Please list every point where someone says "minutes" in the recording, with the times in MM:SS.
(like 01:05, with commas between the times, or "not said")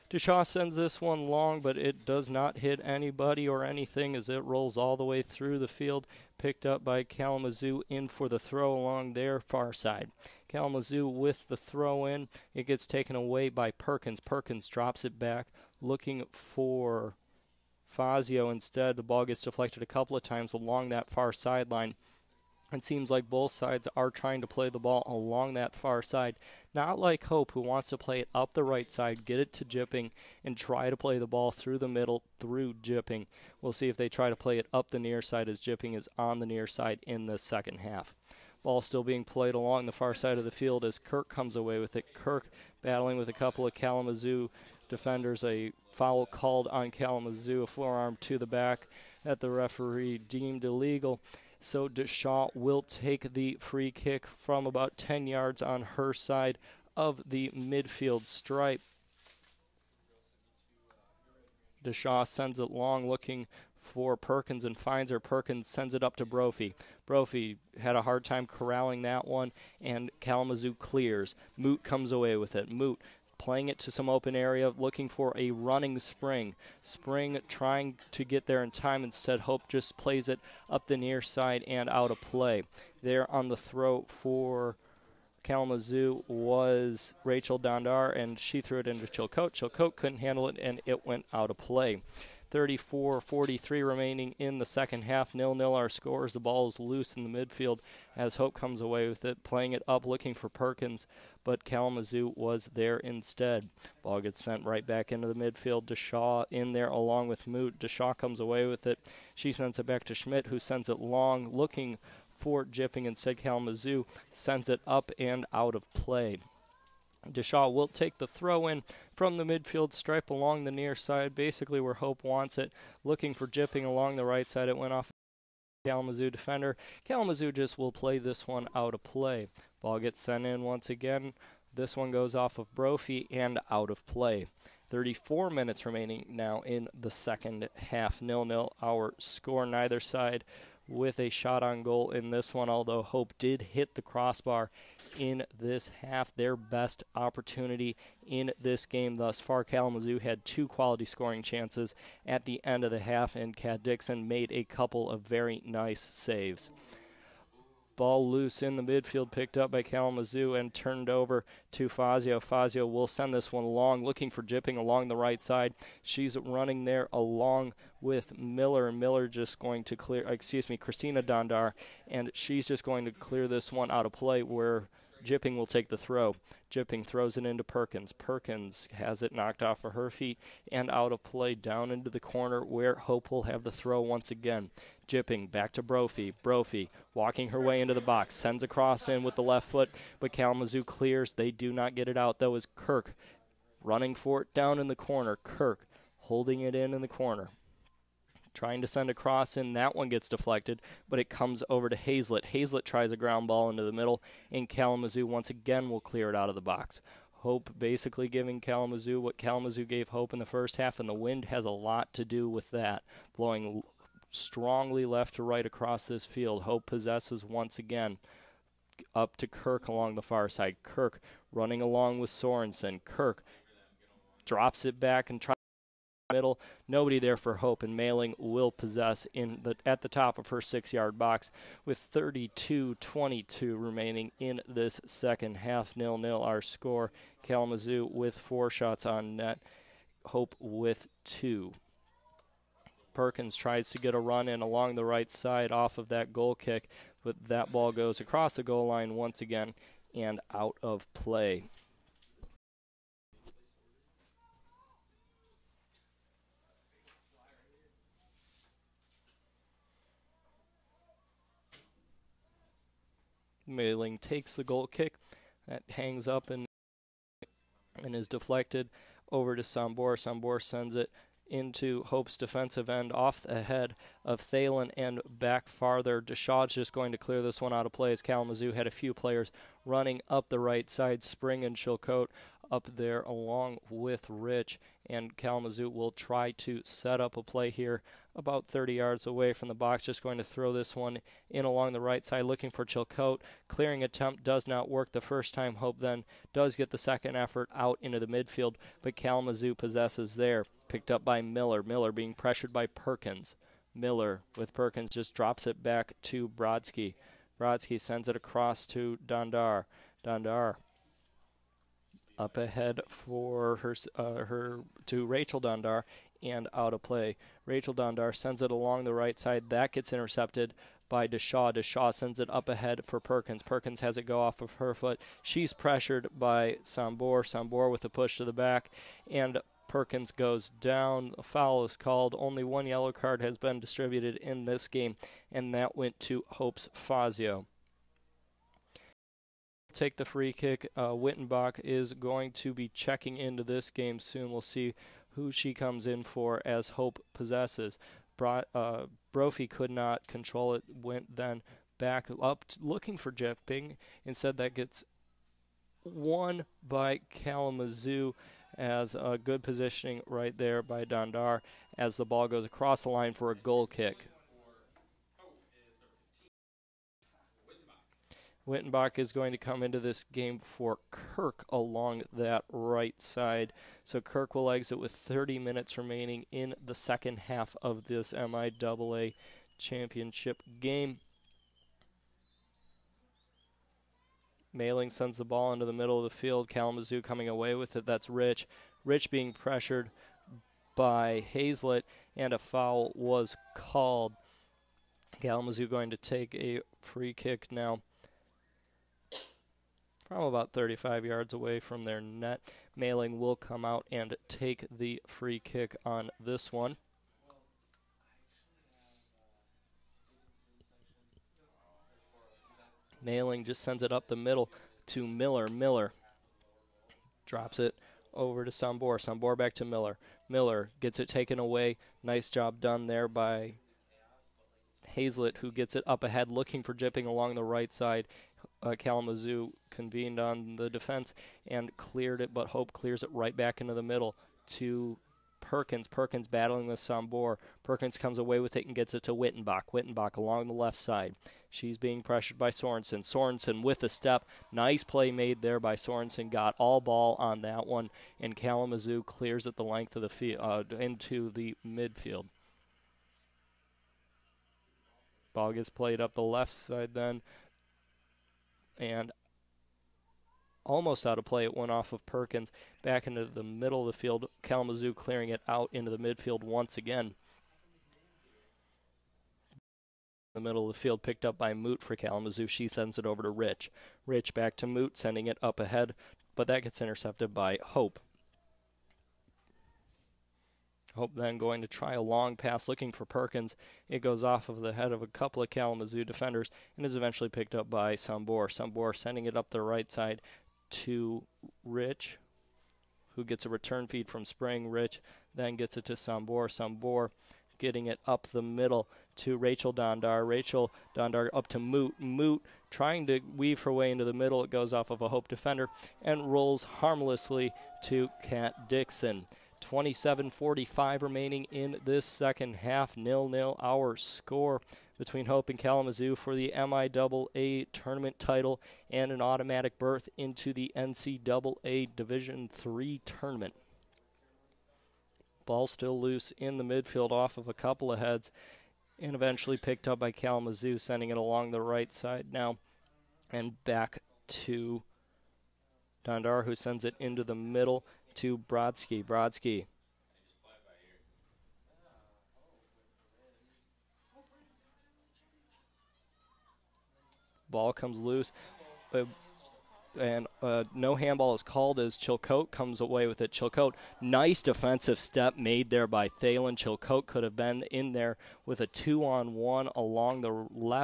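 02:15, 06:15.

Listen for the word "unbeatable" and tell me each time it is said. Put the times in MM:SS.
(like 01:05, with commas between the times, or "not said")
not said.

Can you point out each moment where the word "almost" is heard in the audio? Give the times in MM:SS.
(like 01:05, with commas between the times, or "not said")
07:40.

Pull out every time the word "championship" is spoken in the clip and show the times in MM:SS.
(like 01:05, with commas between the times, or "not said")
06:19.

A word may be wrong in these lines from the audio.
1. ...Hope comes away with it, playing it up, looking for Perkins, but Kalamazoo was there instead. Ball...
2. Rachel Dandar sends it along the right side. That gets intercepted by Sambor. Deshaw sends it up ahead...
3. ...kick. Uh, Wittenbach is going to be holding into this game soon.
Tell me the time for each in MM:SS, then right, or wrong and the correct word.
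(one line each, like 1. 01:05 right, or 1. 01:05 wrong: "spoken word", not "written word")
1. 01:38 right
2. 05:17 wrong: "Deshaw", not "Sambor"
3. 05:40 wrong: "checking", not "holding".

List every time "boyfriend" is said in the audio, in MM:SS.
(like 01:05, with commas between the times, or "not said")
not said.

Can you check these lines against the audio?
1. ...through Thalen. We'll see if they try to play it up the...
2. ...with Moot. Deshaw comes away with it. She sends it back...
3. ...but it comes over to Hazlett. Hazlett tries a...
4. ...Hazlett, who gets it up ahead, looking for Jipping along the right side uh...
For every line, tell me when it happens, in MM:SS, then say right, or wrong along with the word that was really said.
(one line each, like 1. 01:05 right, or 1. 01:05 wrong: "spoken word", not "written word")
1. 00:32 wrong: "Jipping", not "Thalen"
2. 01:47 right
3. 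03:21 right
4. 07:05 right.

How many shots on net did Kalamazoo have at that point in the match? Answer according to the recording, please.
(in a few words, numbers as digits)
4.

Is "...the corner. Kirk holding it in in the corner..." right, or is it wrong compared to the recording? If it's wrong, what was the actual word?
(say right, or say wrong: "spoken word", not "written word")
right.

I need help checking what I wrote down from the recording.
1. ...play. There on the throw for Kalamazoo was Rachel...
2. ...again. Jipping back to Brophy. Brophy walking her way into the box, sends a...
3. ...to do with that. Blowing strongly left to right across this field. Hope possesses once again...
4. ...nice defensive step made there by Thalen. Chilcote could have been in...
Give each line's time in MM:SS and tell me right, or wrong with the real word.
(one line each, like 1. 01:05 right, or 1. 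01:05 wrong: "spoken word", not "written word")
1. 01:22 right
2. 03:04 right
3. 03:32 right
4. 09:14 right.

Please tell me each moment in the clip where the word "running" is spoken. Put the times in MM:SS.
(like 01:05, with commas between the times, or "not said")
01:15, 02:46, 03:13, 03:41, 04:39.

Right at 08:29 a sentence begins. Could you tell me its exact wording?
27:45 remaining in this second half.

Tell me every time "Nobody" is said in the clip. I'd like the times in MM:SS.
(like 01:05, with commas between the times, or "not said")
03:46.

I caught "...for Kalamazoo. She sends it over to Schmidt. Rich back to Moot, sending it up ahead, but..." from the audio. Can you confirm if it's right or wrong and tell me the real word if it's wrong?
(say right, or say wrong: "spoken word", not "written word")
wrong: "Rich", not "Schmidt".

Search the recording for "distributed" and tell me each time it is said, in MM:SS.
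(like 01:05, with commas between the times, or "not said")
05:33.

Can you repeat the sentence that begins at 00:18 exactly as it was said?
The ball gets deflected a couple of times along that far sideline.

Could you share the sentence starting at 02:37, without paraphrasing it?
Ball loose in the midfield, picked up by Kalamazoo and turned over to Fazio.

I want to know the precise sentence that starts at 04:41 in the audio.
Spring and Chilcote up there along with Rich.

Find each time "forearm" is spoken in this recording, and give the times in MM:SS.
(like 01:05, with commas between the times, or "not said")
00:47.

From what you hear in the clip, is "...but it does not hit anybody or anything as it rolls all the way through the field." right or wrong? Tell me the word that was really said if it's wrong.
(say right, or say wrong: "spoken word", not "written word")
right.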